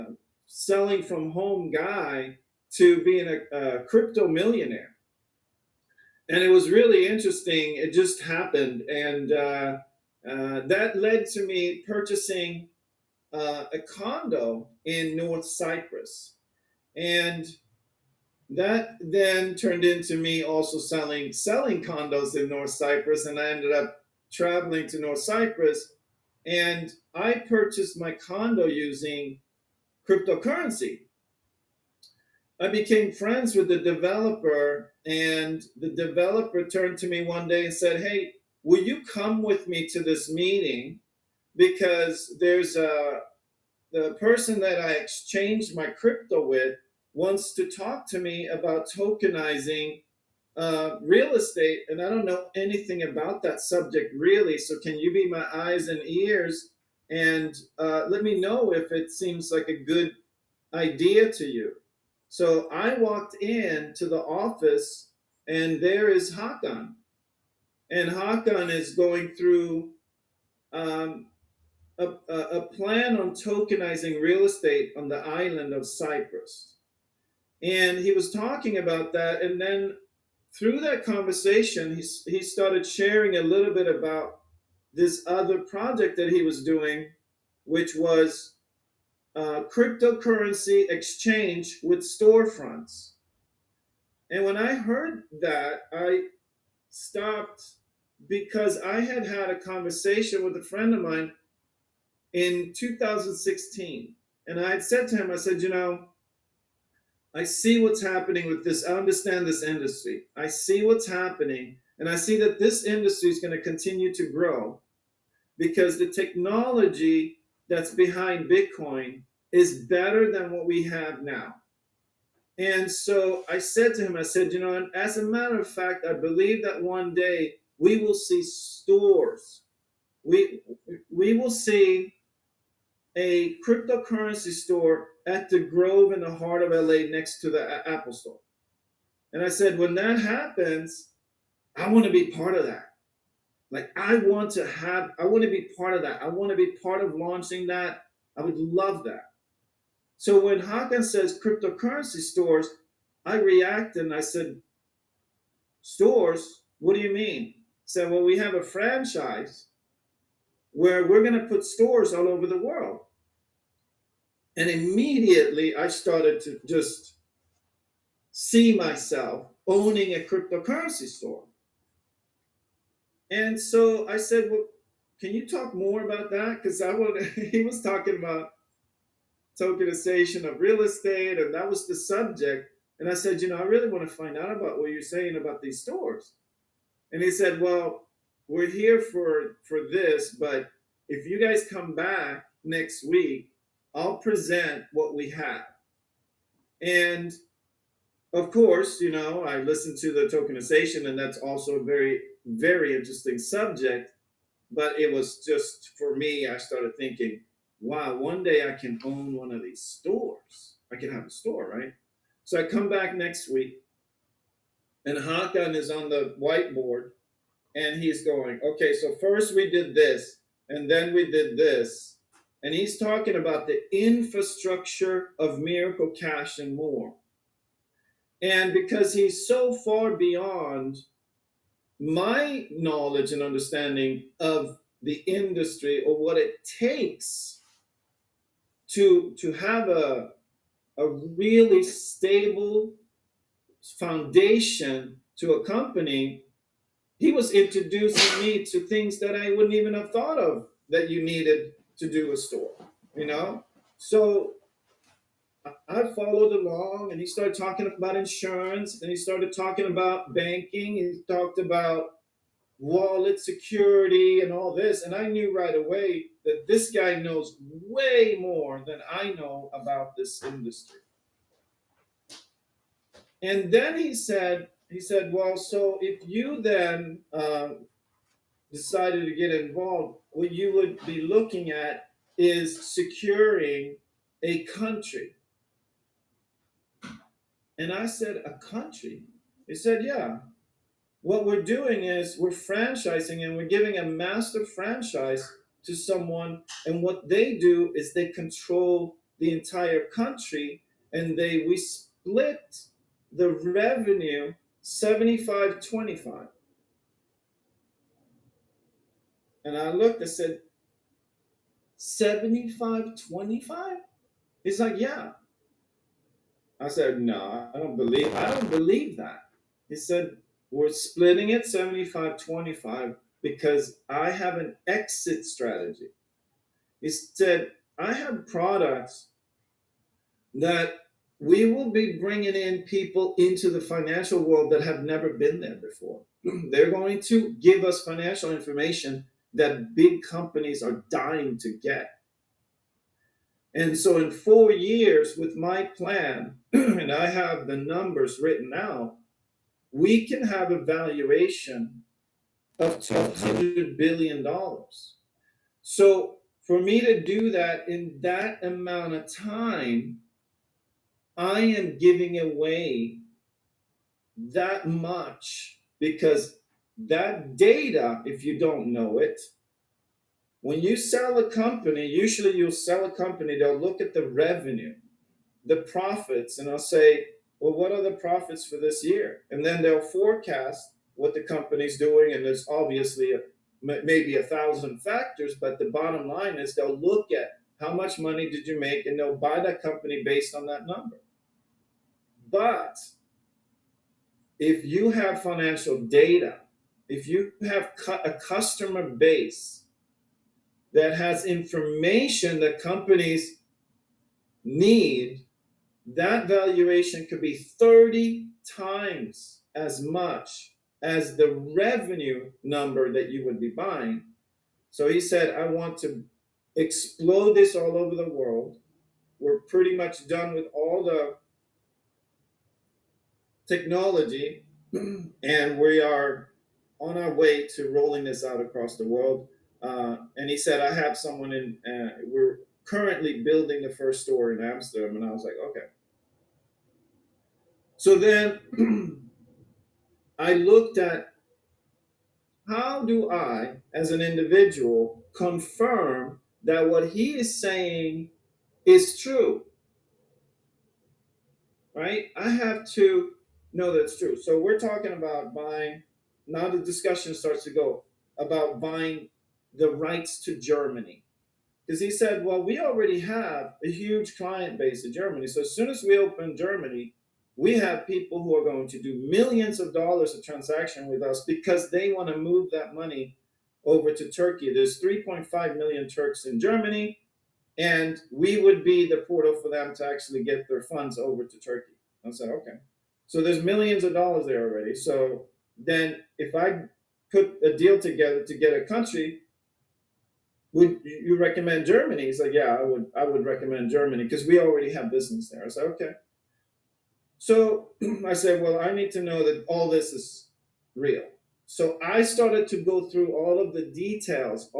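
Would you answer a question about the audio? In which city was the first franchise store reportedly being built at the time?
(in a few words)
Amsterdam.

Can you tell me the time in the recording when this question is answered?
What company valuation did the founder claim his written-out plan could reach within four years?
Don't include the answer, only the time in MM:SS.
05:52.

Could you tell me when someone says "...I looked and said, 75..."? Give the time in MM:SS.
05:09.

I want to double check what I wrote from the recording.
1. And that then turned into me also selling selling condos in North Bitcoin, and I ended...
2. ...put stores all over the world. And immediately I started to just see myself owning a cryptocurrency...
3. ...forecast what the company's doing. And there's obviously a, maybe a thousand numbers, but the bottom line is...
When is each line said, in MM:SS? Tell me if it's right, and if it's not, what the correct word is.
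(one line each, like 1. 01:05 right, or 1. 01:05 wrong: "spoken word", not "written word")
1. 00:16 wrong: "Cyprus", not "Bitcoin"
2. 02:41 right
3. 06:19 wrong: "factors", not "numbers".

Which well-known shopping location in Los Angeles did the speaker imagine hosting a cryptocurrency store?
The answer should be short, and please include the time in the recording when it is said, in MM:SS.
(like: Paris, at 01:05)
The Grove, at 02:15.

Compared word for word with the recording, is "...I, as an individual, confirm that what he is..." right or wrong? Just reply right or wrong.
right.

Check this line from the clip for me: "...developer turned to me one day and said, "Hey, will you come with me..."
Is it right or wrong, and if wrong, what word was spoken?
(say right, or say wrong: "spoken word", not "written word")
right.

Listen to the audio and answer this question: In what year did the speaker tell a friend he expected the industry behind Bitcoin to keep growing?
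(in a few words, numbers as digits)
2016.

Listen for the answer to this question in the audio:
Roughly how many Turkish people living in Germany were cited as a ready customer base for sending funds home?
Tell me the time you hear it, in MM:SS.
07:55.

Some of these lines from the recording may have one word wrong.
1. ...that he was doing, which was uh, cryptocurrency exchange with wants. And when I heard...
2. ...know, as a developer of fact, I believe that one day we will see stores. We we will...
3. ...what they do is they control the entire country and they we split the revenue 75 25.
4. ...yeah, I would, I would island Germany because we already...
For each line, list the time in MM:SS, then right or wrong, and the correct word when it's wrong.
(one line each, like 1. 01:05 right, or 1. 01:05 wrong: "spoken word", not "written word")
1. 01:26 wrong: "storefronts", not "wants"
2. 02:04 wrong: "matter", not "developer"
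3. 04:57 right
4. 08:12 wrong: "recommend", not "island".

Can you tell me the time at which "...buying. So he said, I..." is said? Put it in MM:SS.
06:53.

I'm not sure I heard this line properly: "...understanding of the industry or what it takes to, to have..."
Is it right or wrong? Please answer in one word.
right.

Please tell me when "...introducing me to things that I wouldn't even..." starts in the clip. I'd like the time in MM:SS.
04:07.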